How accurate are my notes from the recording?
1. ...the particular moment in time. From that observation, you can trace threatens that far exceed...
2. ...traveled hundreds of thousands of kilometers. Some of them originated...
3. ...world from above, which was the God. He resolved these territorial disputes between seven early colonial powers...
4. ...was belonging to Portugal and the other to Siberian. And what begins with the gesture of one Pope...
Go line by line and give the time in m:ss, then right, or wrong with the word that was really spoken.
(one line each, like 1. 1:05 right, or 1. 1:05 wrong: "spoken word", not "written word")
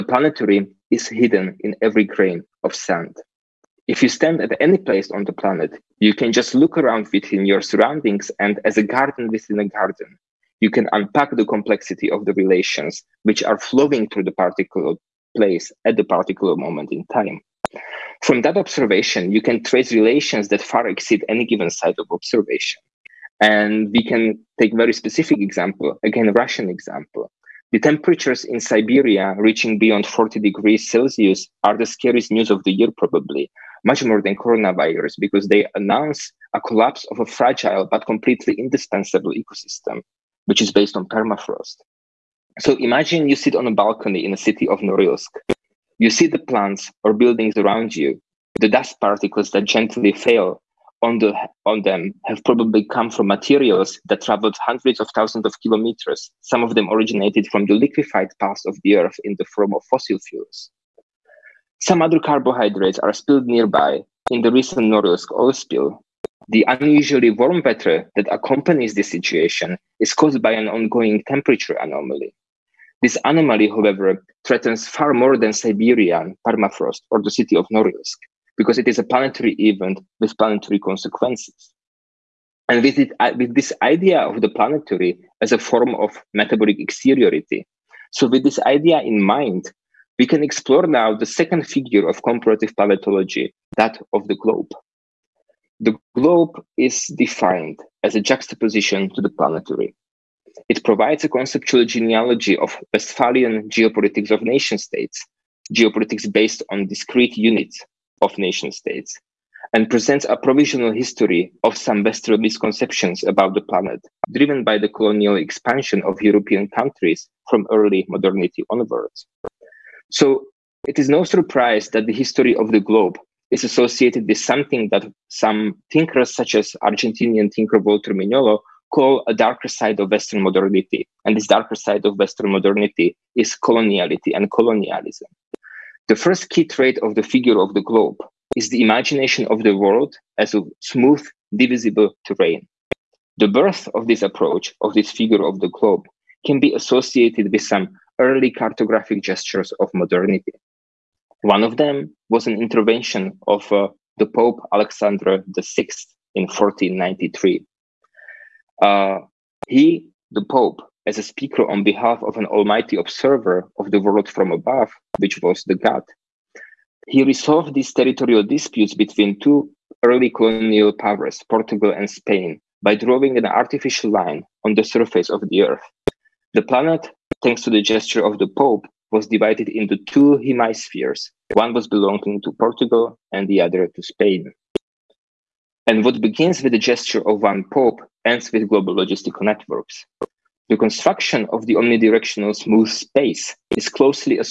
1. 0:15 wrong: "relations", not "threatens"
2. 0:54 right
3. 2:44 wrong: "two", not "seven"
4. 3:01 wrong: "Spain", not "Siberian".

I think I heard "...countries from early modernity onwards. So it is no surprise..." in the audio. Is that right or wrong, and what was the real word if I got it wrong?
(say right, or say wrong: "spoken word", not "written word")
right.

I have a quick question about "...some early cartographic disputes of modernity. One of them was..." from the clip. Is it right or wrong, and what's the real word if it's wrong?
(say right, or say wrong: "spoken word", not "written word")
wrong: "gestures", not "disputes".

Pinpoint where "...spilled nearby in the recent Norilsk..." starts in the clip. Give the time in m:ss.
1:03.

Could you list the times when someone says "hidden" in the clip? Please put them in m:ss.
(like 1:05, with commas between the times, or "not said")
0:01.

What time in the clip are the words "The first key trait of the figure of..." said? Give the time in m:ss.
2:16.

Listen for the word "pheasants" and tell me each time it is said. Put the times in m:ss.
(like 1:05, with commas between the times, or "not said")
not said.